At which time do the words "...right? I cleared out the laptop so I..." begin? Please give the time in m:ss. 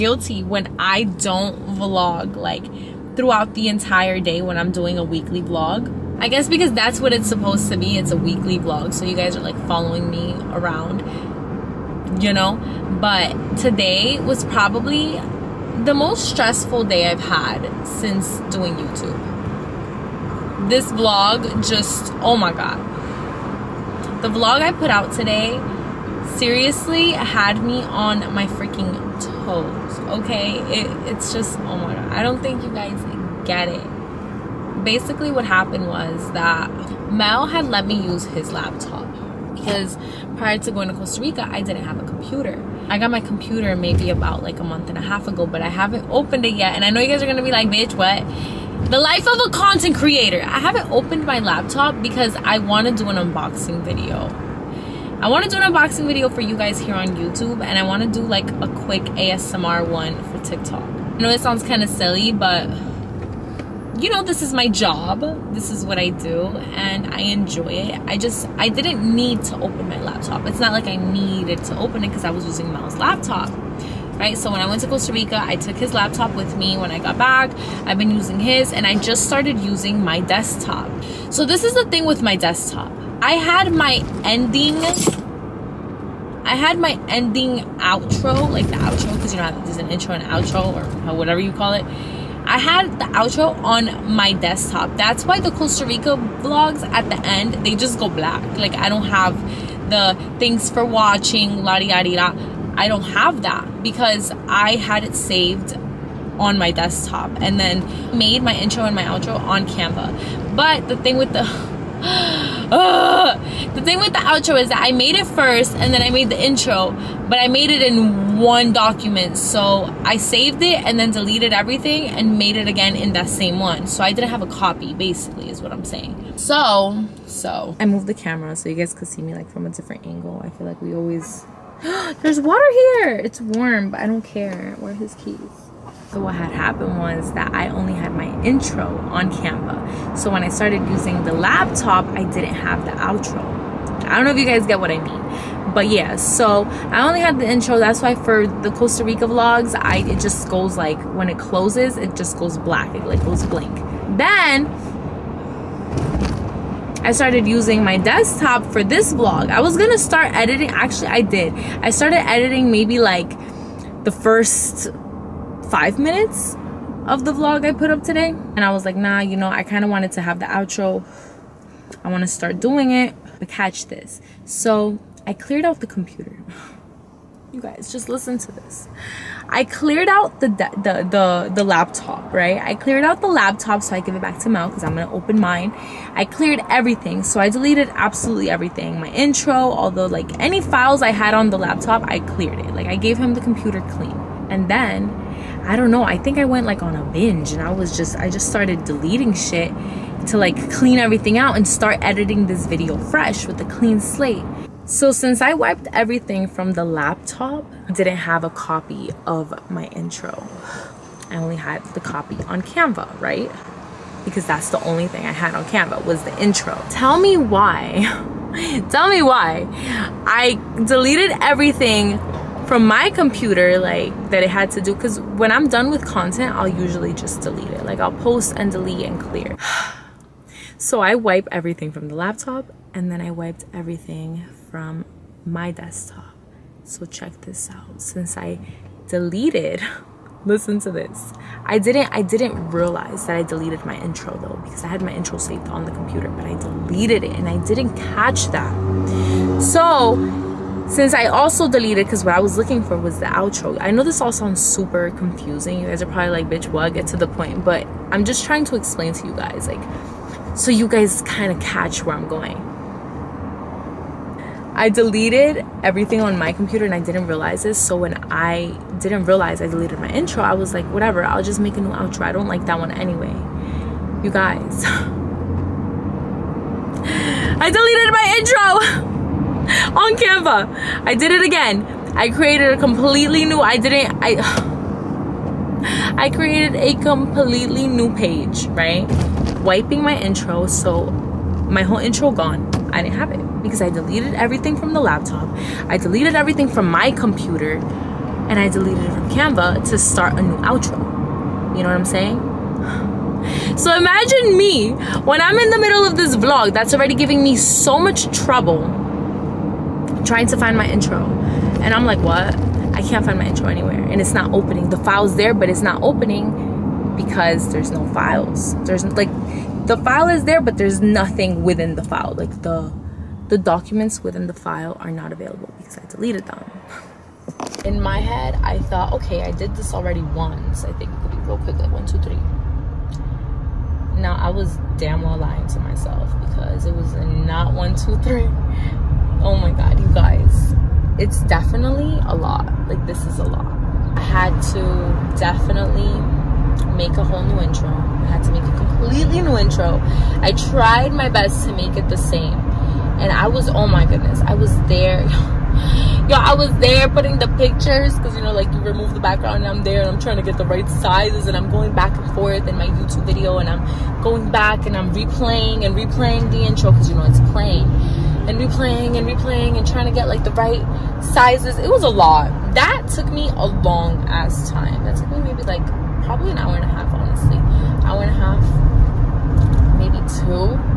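3:02.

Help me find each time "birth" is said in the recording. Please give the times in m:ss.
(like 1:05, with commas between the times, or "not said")
not said.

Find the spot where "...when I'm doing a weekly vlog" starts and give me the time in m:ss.
0:04.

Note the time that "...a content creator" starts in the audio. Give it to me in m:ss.
0:49.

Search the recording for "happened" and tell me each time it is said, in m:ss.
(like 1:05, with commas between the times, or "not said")
0:35, 2:16.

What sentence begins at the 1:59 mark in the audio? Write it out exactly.
So I saved it and then deleted everything and made it again in that same one.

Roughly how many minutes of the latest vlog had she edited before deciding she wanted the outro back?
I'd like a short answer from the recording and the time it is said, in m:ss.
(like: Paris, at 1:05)
5, at 2:45.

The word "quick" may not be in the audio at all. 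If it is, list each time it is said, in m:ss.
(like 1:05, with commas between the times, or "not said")
0:58, 5:31.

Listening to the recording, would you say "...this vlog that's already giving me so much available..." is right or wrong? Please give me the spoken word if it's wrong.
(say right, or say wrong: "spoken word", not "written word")
wrong: "trouble", not "available".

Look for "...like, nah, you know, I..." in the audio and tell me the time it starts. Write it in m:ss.
2:48.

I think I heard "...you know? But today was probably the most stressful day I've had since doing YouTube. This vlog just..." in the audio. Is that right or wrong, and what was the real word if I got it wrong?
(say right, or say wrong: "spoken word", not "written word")
right.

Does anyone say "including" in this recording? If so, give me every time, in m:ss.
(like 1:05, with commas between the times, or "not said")
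not said.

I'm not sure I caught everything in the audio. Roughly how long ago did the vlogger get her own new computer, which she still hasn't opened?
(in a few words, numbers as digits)
a month and a half.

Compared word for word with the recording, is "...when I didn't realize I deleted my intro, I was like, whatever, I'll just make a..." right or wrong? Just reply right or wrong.
right.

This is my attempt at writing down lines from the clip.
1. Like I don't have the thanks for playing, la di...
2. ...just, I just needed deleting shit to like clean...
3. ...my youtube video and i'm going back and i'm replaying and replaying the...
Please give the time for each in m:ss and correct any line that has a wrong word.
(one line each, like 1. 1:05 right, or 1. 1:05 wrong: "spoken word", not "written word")
1. 1:38 wrong: "watching", not "playing"
2. 3:17 wrong: "started", not "needed"
3. 6:02 right.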